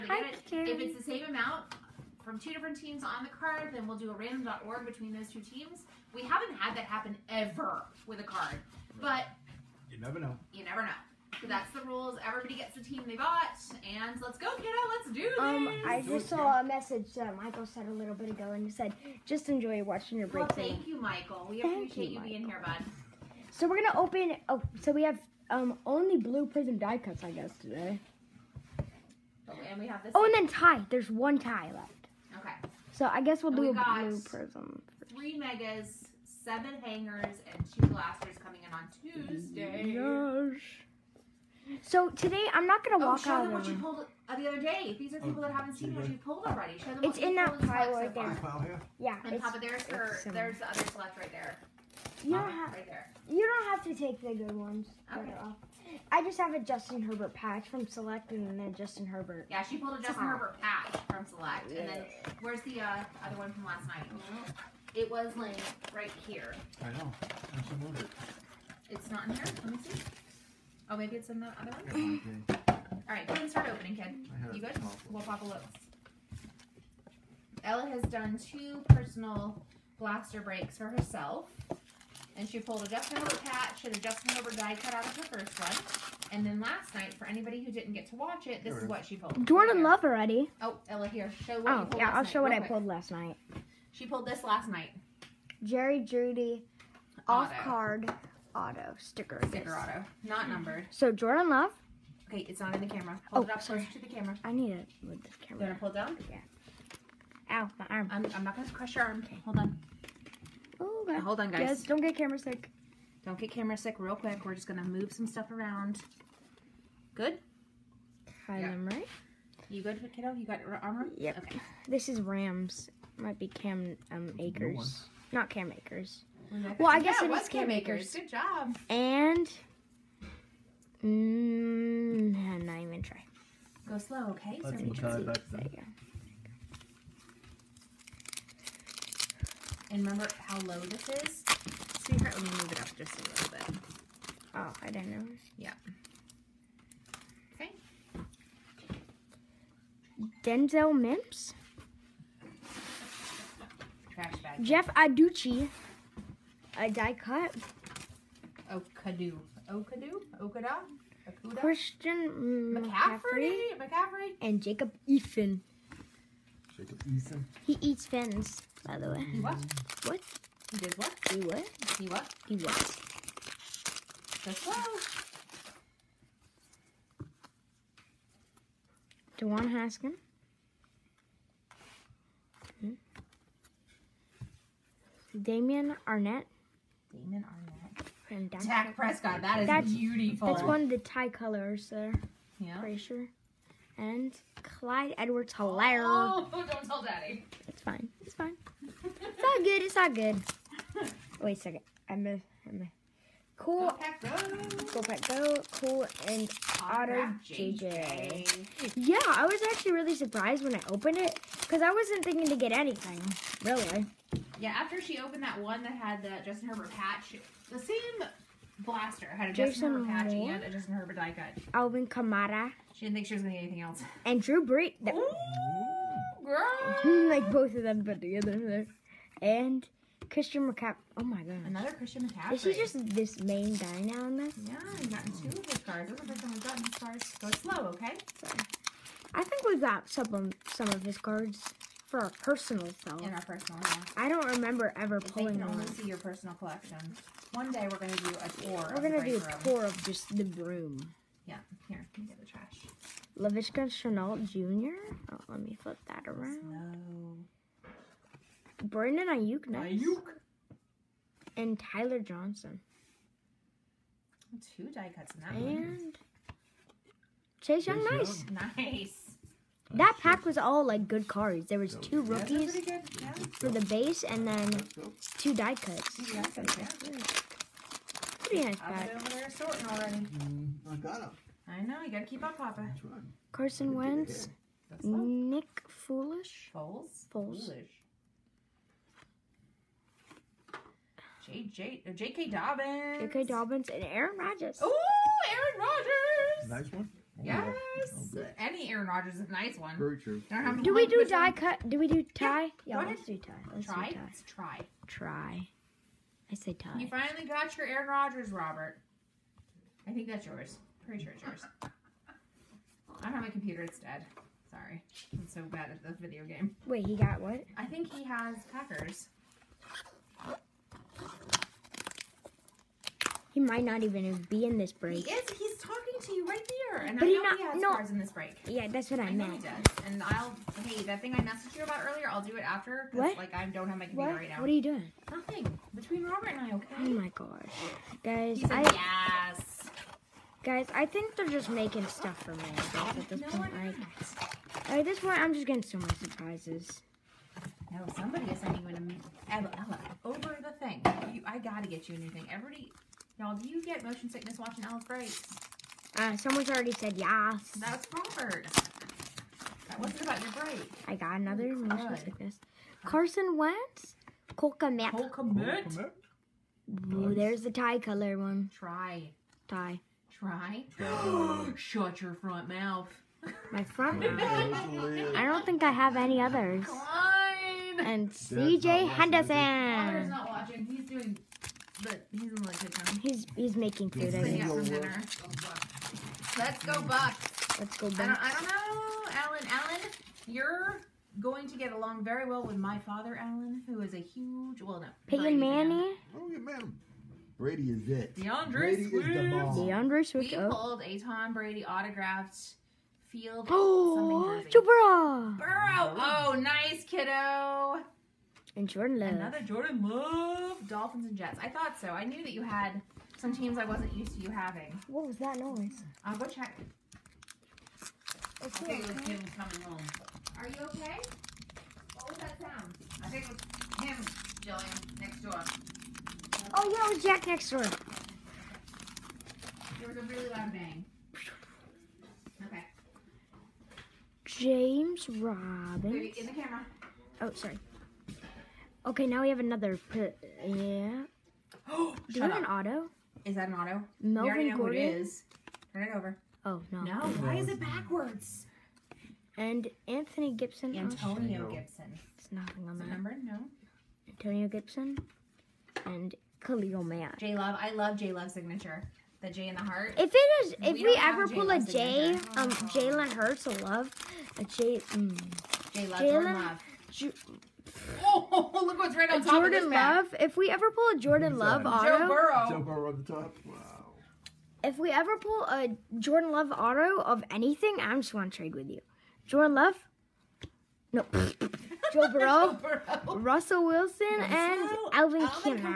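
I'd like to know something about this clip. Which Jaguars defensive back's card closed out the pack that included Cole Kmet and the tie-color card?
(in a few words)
CJ Henderson.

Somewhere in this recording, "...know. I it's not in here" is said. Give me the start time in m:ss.
1:06.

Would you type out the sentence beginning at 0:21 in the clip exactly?
We thank appreciate you, being here, bud.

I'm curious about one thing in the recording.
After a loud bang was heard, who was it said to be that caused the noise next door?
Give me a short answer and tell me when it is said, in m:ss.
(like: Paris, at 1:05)
Jack, at 7:07.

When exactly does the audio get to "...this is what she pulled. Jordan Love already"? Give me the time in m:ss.
1:28.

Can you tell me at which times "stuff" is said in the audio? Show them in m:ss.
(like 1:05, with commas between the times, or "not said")
1:55, 5:42.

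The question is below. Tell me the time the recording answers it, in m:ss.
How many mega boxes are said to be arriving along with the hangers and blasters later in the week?
0:35.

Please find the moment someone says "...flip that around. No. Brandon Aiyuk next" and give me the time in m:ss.
4:15.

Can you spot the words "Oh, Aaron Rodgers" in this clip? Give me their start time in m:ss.
4:54.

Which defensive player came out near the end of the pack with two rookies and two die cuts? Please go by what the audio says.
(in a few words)
Chase Young.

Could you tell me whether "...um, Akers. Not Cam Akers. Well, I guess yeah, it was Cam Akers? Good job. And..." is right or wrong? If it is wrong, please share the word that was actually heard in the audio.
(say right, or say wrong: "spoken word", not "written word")
right.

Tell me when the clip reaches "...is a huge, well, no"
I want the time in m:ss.
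6:34.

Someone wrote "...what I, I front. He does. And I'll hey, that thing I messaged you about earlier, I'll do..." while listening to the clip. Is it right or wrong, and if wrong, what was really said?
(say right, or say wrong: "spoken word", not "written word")
wrong: "meant", not "front".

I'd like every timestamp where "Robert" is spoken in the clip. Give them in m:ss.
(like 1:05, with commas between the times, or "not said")
5:08, 5:36, 5:58.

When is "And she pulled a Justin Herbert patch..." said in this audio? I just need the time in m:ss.
1:22.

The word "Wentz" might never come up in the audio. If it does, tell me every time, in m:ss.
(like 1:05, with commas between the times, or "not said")
4:43, 6:03.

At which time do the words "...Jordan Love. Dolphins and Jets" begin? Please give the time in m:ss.
6:49.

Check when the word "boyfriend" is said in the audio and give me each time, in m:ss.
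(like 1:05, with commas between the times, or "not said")
not said.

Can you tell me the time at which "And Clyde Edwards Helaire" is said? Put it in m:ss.
3:13.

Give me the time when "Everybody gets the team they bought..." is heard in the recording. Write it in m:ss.
0:12.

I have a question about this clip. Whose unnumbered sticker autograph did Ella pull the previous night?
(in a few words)
Jerry Jeudy.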